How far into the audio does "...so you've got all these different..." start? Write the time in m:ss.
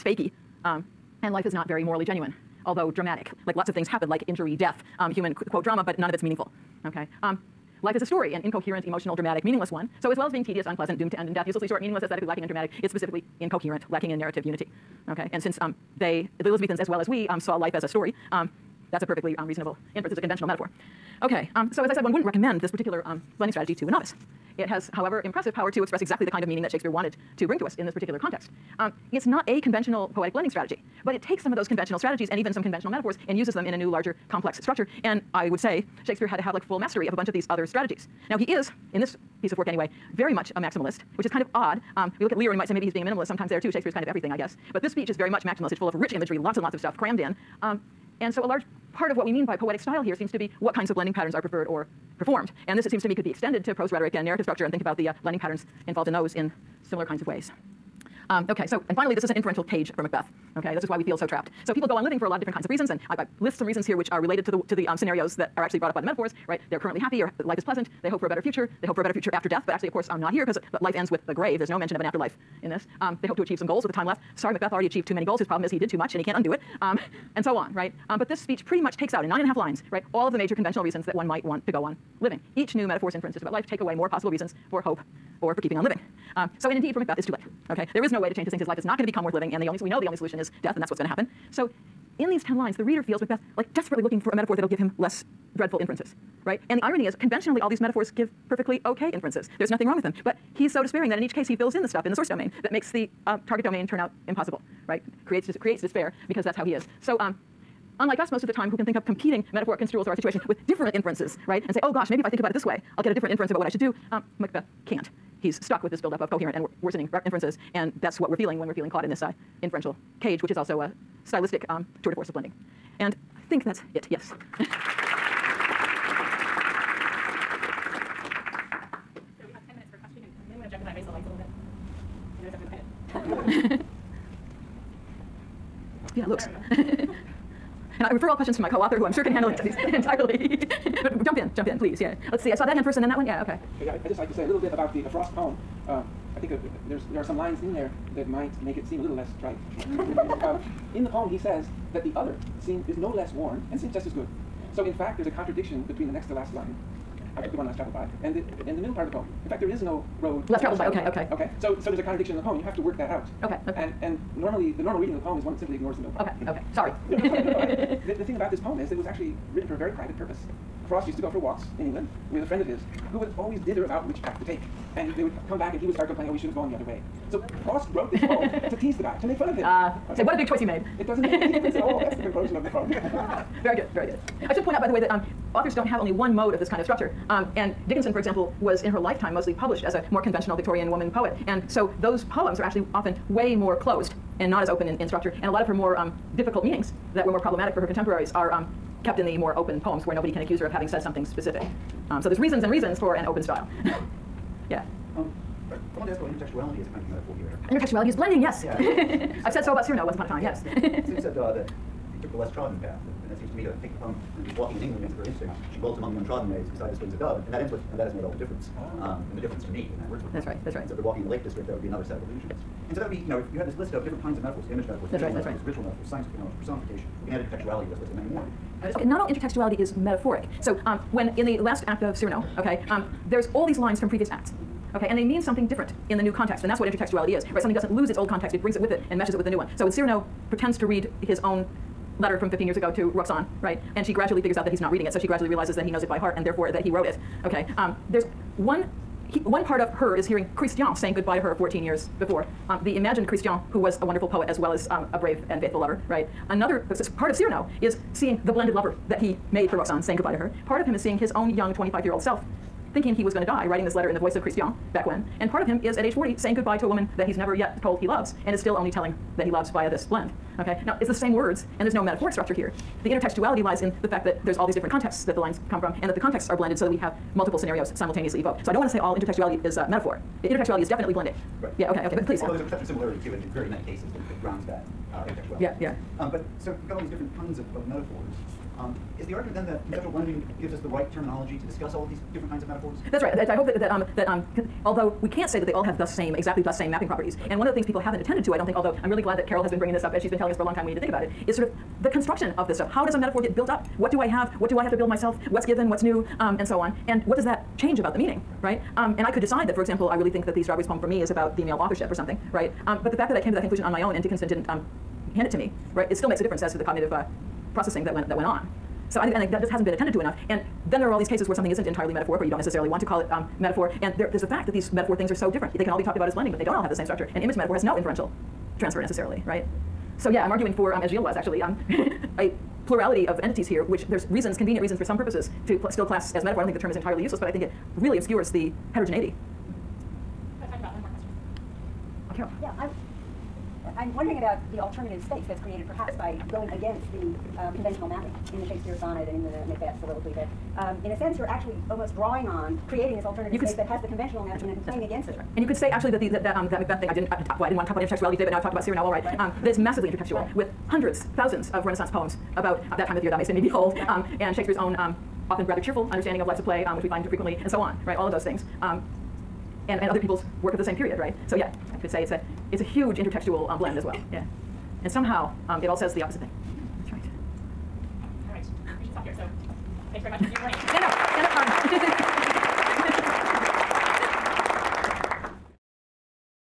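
4:46.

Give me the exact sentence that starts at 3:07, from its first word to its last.
Um, and Dickinson, for example, was in her lifetime mostly published as a more conventional Victorian woman poet.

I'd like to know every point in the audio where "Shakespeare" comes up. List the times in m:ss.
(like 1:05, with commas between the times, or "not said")
0:26, 0:36, 0:43, 5:48, 6:04.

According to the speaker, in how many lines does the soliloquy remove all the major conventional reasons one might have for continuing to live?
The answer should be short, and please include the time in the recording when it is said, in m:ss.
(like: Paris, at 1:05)
9 and a half, at 1:19.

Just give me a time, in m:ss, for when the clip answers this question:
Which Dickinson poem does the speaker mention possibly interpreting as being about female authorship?
5:10.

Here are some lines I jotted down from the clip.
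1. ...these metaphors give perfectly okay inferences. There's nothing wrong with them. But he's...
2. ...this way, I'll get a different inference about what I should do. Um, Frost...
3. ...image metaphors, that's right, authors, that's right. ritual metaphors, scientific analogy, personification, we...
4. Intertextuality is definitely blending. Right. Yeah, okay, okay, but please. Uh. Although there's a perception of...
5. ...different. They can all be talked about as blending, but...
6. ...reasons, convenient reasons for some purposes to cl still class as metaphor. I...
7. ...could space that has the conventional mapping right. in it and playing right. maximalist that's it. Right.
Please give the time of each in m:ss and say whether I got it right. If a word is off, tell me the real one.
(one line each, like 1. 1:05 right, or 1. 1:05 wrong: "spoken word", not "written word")
1. 1:37 right
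2. 1:52 wrong: "Macbeth", not "Frost"
3. 3:44 wrong: "metaphors", not "authors"
4. 4:40 right
5. 5:25 right
6. 5:34 right
7. 5:53 wrong: "against", not "maximalist".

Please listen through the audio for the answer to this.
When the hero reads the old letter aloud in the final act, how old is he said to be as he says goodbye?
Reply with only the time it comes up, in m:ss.
4:26.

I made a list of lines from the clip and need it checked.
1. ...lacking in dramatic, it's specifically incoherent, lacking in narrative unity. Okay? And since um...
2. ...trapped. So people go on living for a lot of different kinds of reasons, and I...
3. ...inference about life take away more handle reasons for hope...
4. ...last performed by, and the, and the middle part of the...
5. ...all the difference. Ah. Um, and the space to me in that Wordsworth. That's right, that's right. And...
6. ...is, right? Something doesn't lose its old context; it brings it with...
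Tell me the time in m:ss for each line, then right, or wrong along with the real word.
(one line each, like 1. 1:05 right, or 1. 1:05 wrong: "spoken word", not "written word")
1. 0:12 right
2. 1:01 right
3. 1:23 wrong: "possible", not "handle"
4. 2:37 wrong: "traveled", not "performed"
5. 3:38 wrong: "difference", not "space"
6. 3:57 right.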